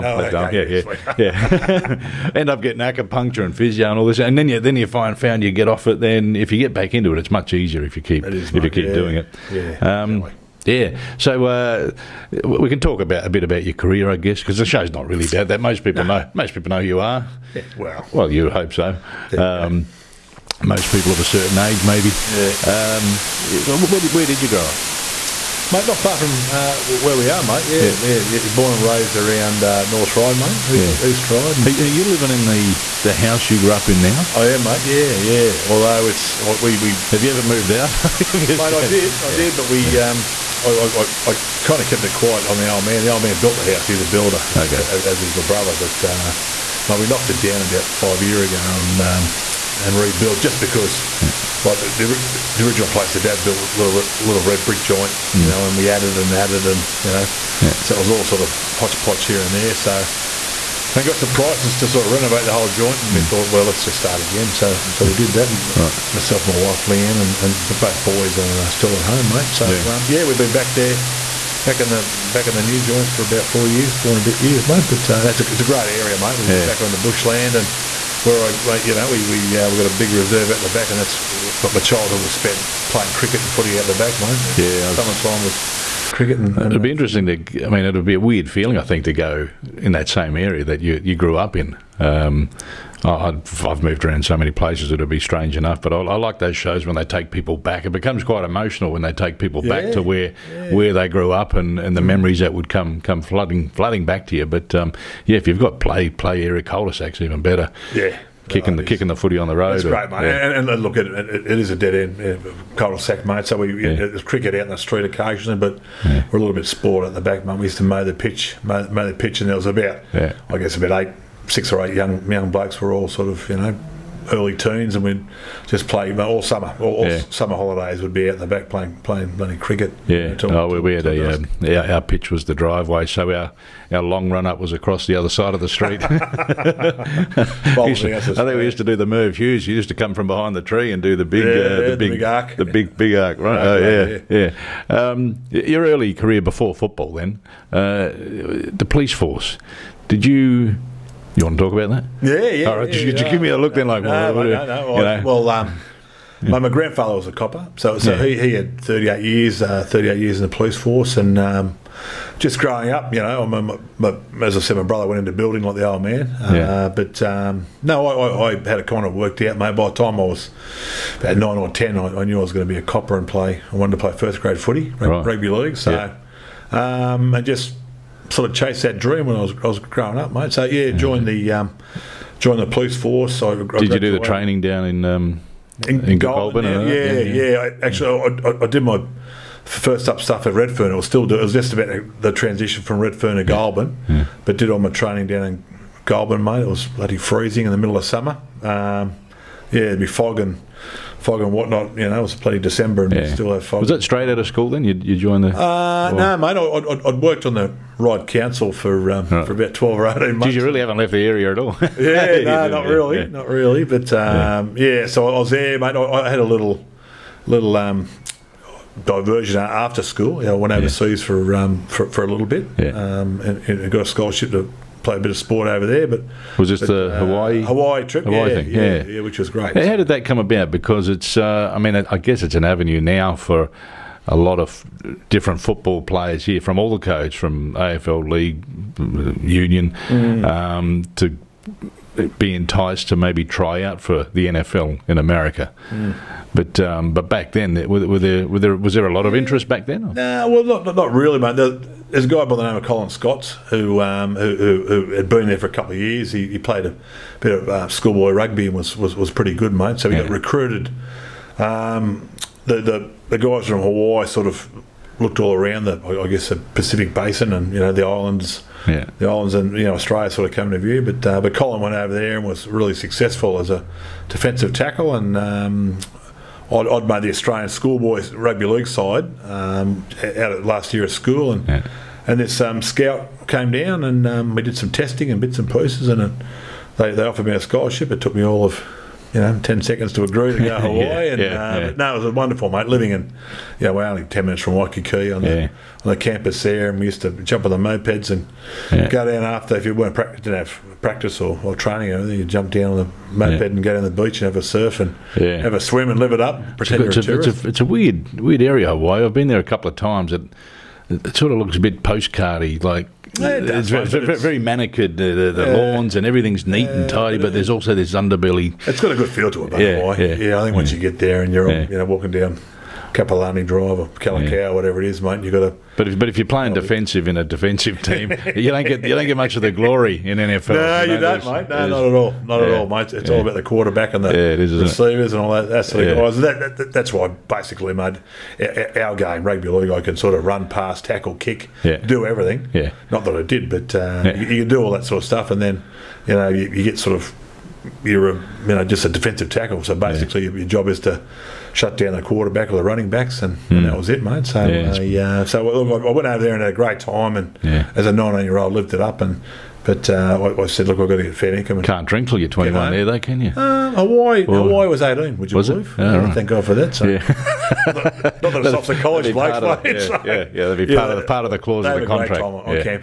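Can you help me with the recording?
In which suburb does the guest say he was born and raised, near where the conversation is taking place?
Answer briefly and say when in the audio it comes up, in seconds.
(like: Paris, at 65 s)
East Ryde, at 31 s.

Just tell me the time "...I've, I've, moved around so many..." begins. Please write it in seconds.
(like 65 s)
93 s.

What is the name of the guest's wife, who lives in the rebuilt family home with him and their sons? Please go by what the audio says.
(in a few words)
Leanne.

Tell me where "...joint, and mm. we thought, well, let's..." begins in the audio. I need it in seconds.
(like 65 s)
62 s.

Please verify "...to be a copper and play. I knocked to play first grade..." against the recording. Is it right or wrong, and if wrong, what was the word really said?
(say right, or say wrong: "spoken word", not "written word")
wrong: "wanted", not "knocked".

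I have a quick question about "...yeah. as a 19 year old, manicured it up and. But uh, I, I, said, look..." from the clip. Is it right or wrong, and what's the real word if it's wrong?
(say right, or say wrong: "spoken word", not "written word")
wrong: "lived", not "manicured".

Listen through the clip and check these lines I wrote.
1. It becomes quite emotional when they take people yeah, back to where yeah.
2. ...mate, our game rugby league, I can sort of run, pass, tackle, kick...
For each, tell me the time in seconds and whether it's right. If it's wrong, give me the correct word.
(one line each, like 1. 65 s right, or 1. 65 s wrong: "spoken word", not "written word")
1. 97 s right
2. 337 s right.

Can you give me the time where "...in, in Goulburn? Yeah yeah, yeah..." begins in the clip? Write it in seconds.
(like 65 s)
185 s.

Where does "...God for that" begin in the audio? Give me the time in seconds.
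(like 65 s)
366 s.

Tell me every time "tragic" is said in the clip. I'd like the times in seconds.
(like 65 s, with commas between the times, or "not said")
not said.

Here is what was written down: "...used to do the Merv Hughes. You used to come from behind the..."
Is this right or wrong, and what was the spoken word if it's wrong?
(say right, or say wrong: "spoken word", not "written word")
right.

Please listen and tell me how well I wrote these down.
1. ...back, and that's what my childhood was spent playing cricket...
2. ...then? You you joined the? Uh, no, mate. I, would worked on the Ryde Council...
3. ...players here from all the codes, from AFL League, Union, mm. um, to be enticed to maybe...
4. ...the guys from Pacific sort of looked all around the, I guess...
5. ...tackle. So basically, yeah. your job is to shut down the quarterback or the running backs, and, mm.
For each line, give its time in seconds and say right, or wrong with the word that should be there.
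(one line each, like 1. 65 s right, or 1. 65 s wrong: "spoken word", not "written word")
1. 80 s right
2. 204 s right
3. 236 s right
4. 263 s wrong: "Hawaii", not "Pacific"
5. 349 s right.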